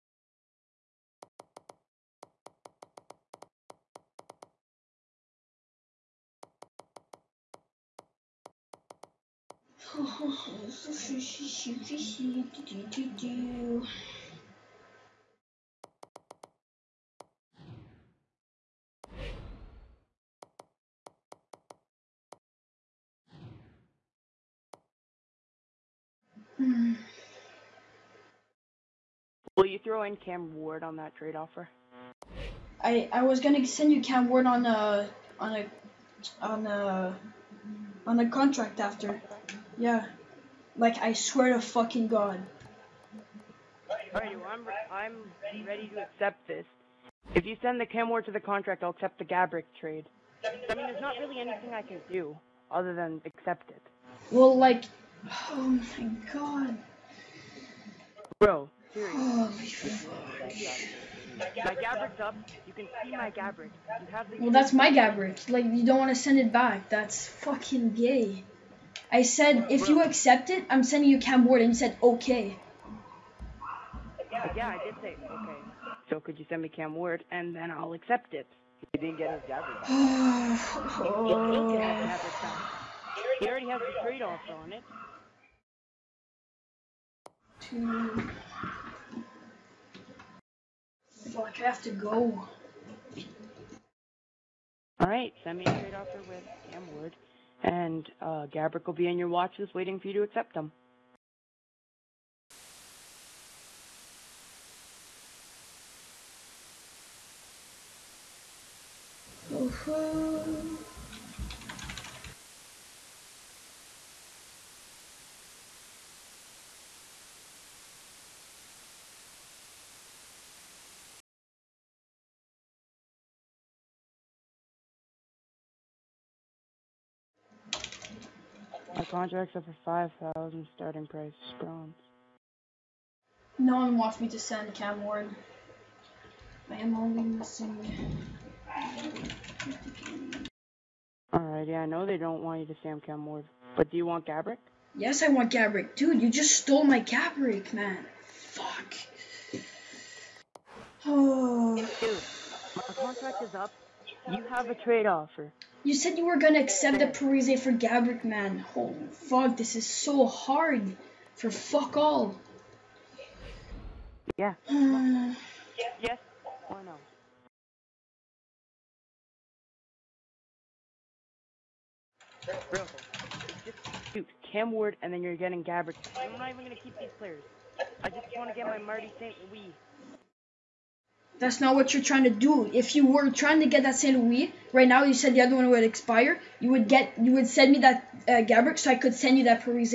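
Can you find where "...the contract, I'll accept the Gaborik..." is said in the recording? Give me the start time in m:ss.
0:48.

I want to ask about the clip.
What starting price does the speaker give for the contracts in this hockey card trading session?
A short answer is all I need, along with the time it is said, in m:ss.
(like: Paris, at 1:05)
5000, at 2:10.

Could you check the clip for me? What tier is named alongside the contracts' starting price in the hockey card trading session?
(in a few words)
Bronze.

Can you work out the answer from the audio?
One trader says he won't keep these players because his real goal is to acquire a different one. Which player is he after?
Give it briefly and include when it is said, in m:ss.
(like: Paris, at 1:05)
Marty St. Louis, at 2:58.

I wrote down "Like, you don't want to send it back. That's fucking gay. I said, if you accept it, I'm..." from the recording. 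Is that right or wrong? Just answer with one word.
right.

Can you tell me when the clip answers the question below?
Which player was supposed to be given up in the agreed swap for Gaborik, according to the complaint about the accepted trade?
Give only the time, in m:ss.
2:37.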